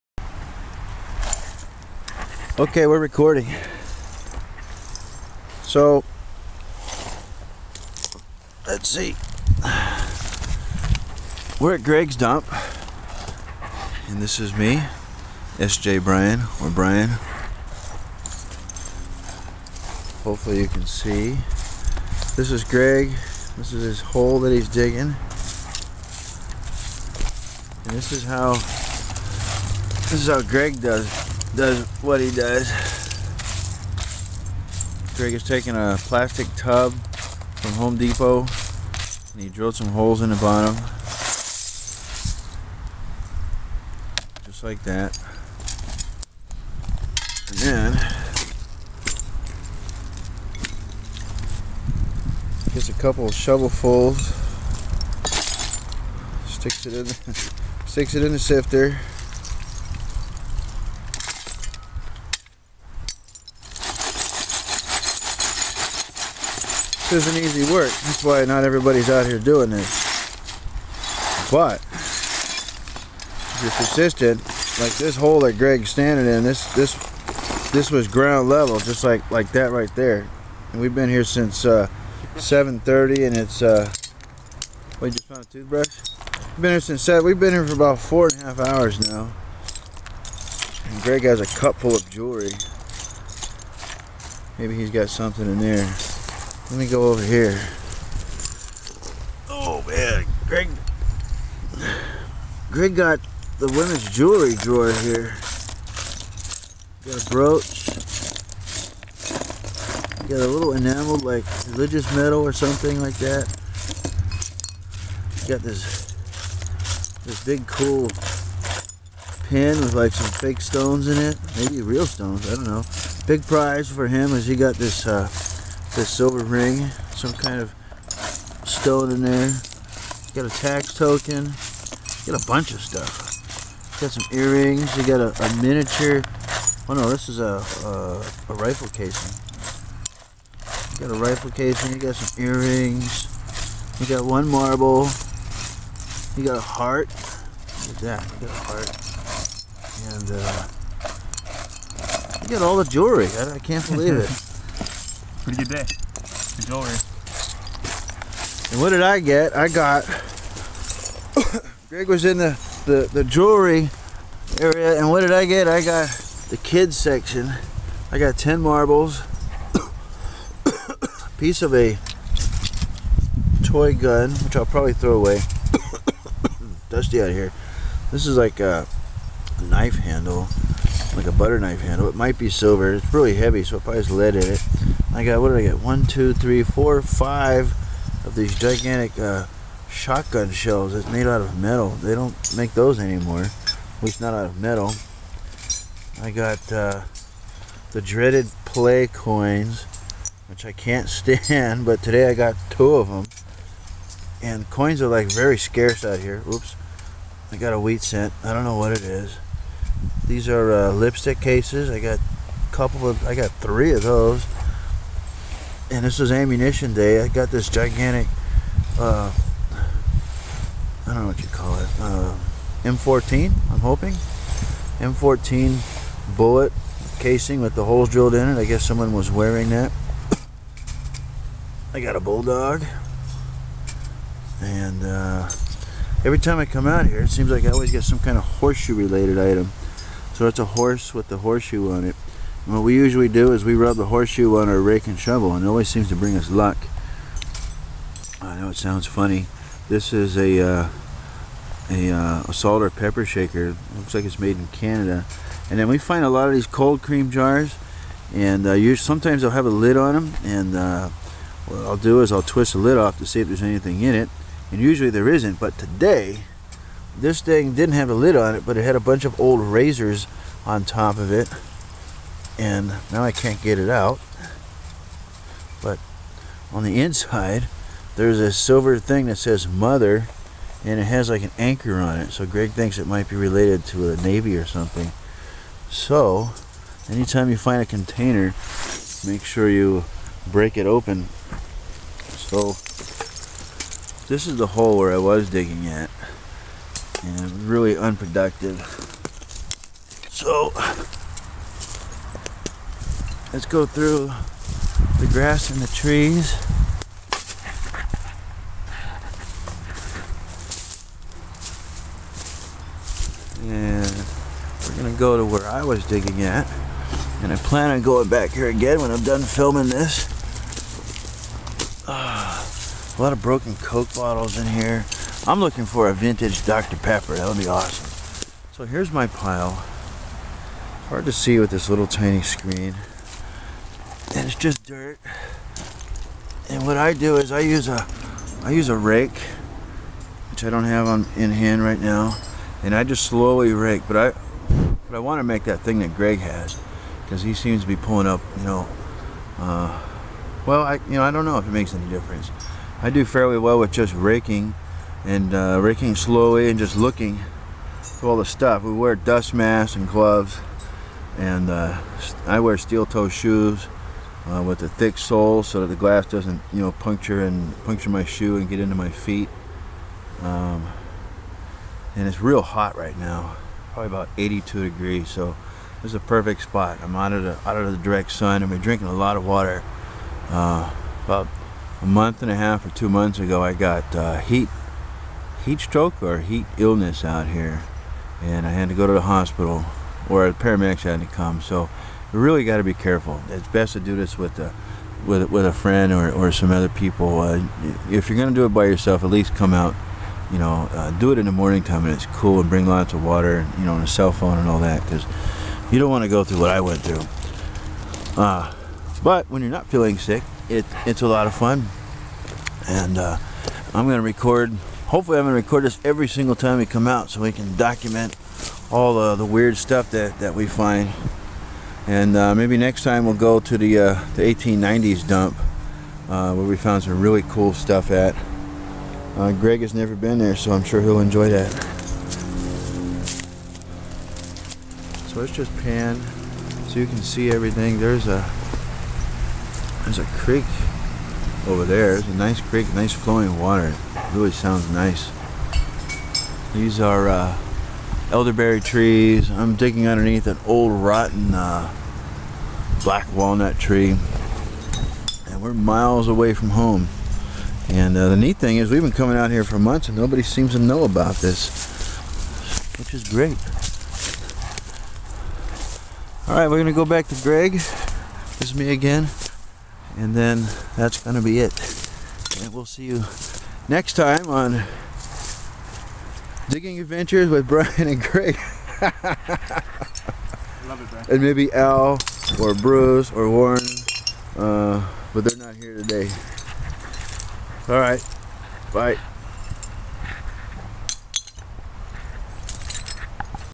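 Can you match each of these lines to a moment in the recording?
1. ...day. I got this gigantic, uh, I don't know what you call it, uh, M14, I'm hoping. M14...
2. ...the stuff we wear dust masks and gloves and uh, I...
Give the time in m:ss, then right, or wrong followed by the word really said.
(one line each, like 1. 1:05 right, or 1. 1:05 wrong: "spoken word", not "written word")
1. 3:36 right
2. 5:58 right.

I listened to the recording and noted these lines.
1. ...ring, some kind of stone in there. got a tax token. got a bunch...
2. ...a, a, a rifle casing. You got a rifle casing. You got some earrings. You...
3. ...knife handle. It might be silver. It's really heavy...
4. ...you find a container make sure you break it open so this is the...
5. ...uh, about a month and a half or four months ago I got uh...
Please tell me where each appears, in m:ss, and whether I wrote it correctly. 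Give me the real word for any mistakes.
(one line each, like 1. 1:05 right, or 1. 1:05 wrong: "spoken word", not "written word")
1. 2:06 right
2. 2:17 right
3. 3:01 right
4. 4:47 right
5. 6:20 wrong: "two", not "four".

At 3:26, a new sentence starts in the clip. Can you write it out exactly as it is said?
Oops, I got a wheat cent.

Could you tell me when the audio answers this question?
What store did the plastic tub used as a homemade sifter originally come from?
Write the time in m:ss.
0:37.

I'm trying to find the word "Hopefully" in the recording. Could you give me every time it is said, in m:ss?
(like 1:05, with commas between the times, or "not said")
0:20, 6:55.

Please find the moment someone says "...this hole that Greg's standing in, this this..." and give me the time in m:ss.
1:14.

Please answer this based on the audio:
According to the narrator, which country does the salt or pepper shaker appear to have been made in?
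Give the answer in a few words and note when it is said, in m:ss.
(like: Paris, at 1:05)
Canada, at 4:14.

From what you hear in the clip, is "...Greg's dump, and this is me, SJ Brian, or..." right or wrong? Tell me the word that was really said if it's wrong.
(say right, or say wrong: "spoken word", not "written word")
right.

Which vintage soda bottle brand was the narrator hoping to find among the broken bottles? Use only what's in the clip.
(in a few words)
Dr. Pepper.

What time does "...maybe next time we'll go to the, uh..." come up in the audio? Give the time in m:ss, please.
7:02.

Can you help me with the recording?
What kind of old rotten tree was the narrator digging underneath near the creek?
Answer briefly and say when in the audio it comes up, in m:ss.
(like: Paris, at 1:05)
Black walnut, at 7:33.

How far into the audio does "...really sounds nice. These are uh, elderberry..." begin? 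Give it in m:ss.
7:24.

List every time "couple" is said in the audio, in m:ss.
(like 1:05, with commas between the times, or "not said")
0:52, 3:32.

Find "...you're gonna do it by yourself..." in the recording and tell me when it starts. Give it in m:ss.
6:38.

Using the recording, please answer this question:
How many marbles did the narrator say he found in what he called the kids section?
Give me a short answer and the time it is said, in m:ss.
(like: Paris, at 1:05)
10, at 2:48.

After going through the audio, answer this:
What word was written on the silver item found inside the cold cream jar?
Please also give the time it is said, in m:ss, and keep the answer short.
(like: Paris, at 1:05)
Mother, at 4:39.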